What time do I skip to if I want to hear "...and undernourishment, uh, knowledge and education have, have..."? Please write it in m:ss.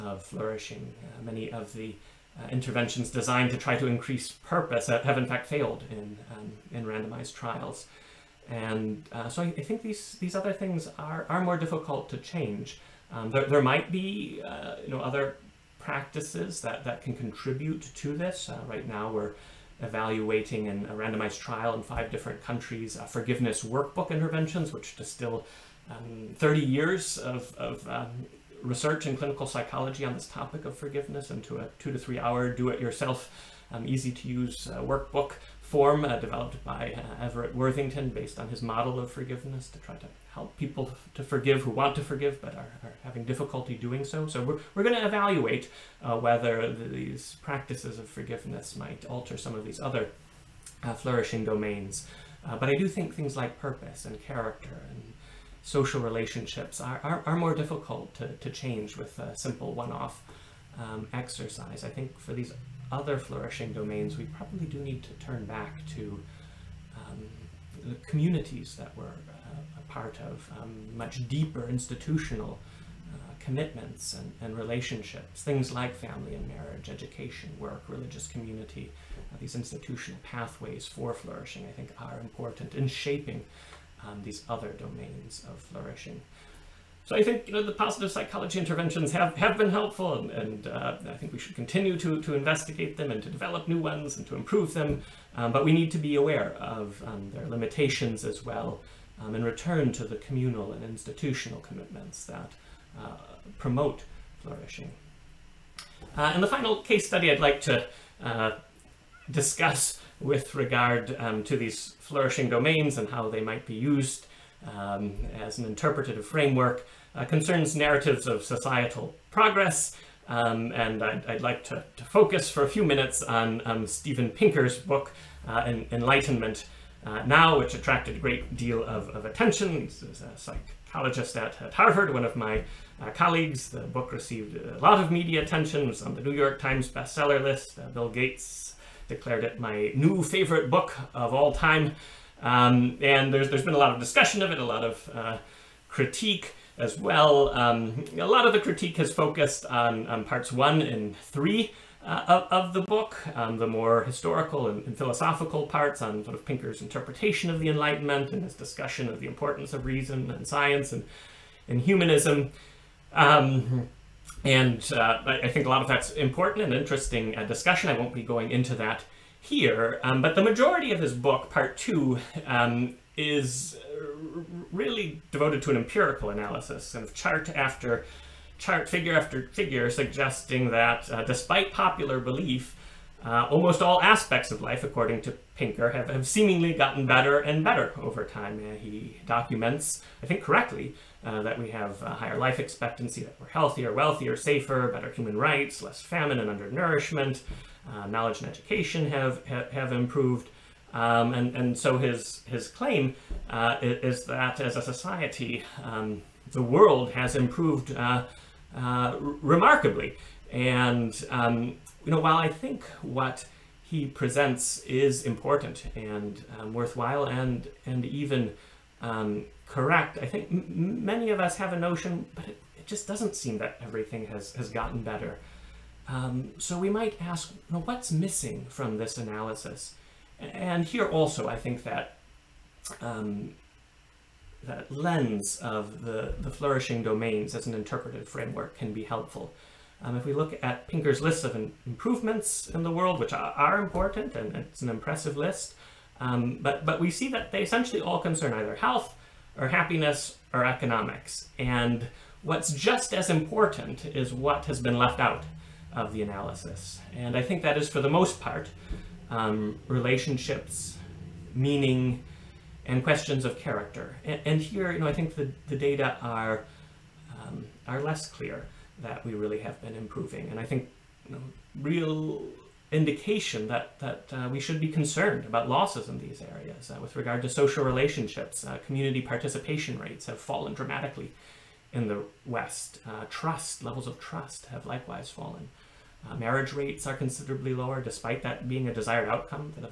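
3:16.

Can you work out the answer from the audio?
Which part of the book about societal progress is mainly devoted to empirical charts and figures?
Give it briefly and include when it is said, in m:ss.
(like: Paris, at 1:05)
Part 2, at 2:51.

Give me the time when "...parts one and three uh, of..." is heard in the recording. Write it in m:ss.
2:30.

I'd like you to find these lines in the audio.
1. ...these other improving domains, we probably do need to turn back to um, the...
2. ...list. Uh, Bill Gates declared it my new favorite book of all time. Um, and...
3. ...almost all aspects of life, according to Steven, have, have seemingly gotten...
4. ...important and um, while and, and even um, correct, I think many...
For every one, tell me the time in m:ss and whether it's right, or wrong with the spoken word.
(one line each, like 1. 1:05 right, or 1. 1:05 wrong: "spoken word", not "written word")
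1. 1:02 wrong: "flourishing", not "improving"
2. 2:17 right
3. 3:03 wrong: "Pinker", not "Steven"
4. 3:35 wrong: "worthwhile", not "while".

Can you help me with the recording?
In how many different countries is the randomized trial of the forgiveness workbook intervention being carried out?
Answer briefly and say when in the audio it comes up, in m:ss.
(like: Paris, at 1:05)
5, at 0:21.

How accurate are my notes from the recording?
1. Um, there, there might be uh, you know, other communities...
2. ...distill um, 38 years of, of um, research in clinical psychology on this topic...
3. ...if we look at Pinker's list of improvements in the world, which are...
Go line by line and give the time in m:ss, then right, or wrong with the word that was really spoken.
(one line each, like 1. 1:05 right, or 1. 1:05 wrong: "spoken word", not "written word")
1. 0:13 wrong: "practices", not "communities"
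2. 0:24 wrong: "30", not "38"
3. 4:00 right.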